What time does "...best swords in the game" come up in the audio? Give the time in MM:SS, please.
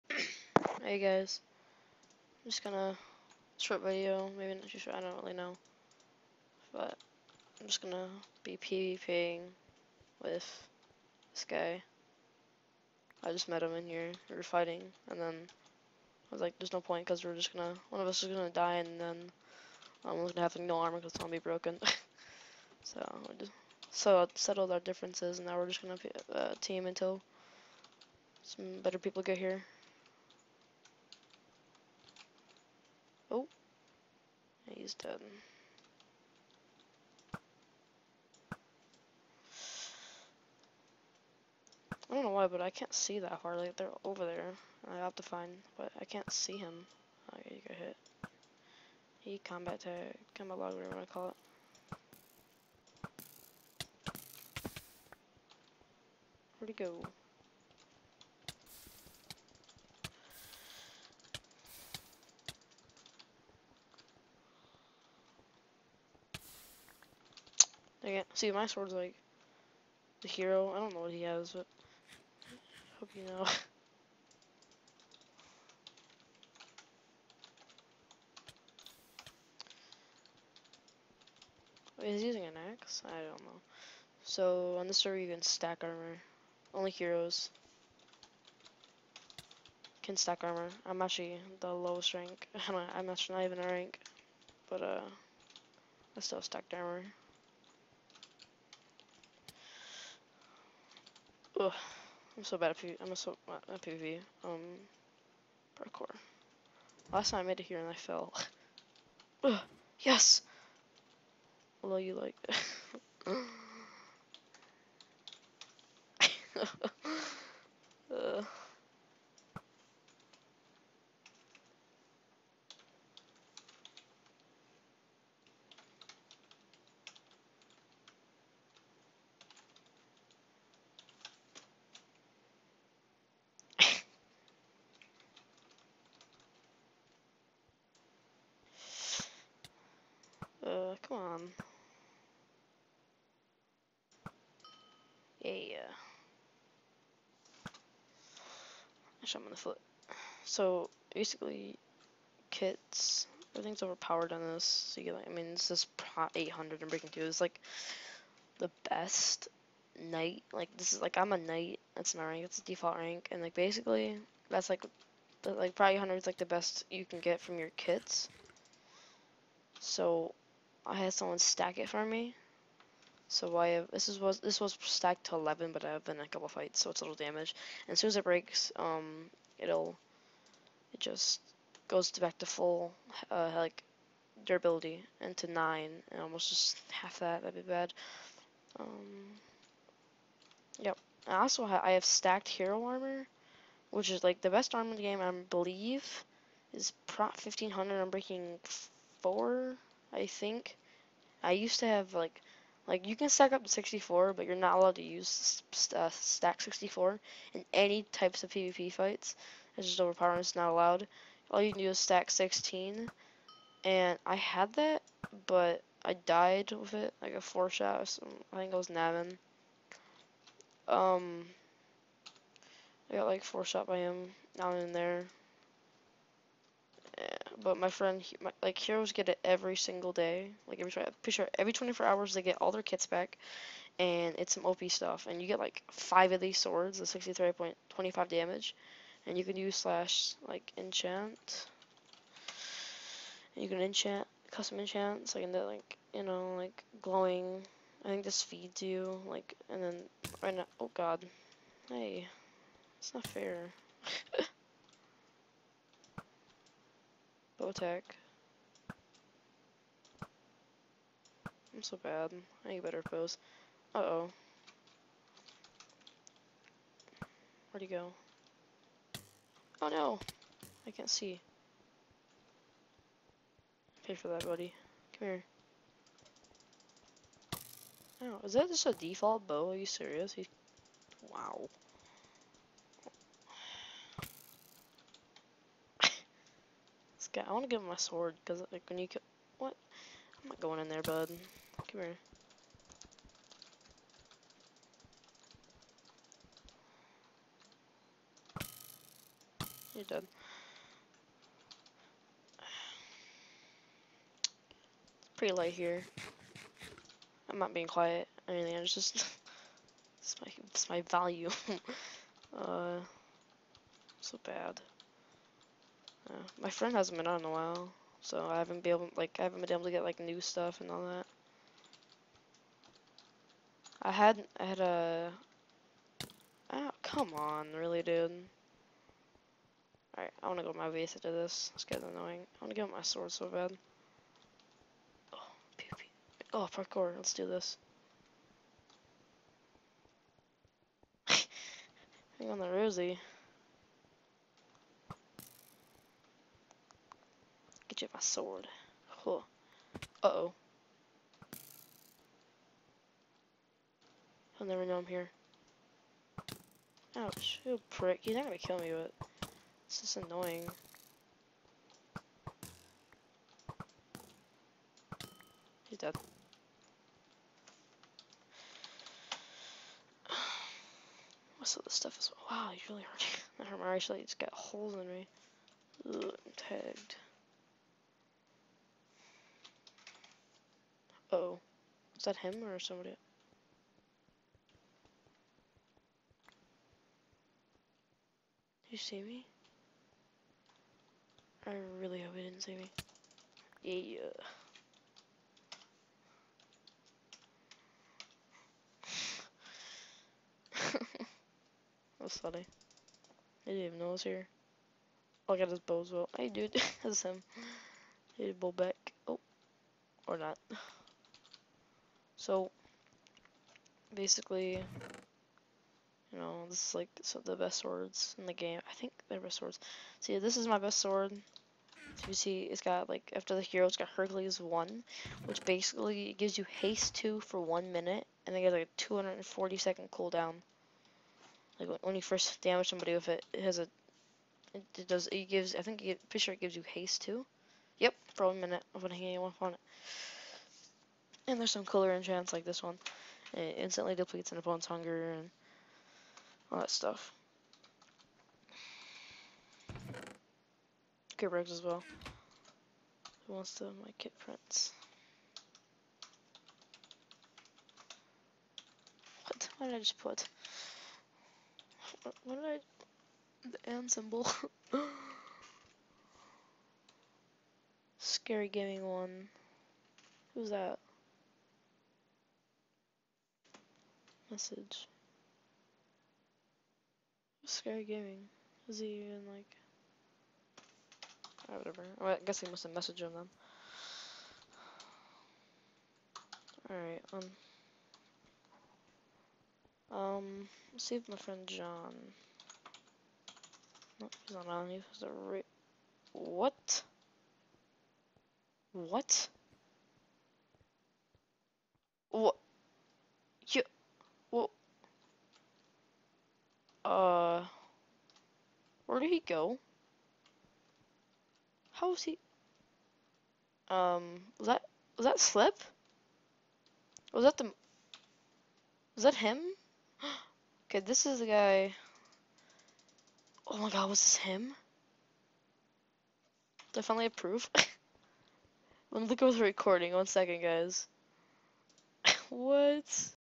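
06:57.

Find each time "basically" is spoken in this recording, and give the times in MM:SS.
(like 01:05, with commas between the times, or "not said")
02:31, 02:43, 06:54, 07:05.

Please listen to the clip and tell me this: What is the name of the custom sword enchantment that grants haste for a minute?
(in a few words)
Hercules.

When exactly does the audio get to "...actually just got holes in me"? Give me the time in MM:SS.
06:13.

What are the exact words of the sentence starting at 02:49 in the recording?
So I had someone stack it for me.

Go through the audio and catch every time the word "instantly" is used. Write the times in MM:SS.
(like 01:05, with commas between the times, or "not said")
07:23.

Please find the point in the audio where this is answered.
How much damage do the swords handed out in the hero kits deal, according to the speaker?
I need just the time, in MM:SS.
03:56.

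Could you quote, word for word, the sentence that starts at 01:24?
So, on this server, you can stack armor.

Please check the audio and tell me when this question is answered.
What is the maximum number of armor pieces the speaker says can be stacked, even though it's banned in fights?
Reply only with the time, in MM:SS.
03:23.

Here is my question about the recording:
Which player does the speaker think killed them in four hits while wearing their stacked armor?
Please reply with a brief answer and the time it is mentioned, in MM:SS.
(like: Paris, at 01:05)
Navin, at 03:38.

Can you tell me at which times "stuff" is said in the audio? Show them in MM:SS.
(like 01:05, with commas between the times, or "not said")
03:54, 05:20, 06:11, 07:26.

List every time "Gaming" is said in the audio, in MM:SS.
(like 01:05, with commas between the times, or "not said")
07:48, 07:58.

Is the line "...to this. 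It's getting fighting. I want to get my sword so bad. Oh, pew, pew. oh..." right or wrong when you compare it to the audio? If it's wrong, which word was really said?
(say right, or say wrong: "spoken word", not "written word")
wrong: "annoying", not "fighting".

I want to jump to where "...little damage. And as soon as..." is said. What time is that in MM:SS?
02:57.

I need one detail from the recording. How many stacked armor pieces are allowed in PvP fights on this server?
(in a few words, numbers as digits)
16.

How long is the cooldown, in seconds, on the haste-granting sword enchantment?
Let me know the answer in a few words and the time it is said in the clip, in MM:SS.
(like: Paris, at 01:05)
240 seconds, at 07:08.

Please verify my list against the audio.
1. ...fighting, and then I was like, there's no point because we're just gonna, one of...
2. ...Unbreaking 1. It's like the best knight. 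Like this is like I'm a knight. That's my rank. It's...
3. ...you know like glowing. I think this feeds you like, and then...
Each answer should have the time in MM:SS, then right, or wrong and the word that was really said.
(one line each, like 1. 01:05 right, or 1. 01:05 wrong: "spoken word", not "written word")
1. 00:14 right
2. 02:36 wrong: "2", not "1"
3. 04:06 right.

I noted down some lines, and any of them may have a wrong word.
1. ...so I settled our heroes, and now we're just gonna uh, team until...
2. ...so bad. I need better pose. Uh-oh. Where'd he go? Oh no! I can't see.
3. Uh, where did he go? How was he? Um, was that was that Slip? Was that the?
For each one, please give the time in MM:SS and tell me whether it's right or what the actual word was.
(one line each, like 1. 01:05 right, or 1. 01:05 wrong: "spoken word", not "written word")
1. 00:23 wrong: "differences", not "heroes"
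2. 04:21 right
3. 08:27 right.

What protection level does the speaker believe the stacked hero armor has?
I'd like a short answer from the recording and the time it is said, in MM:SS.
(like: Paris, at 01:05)
1500, at 03:17.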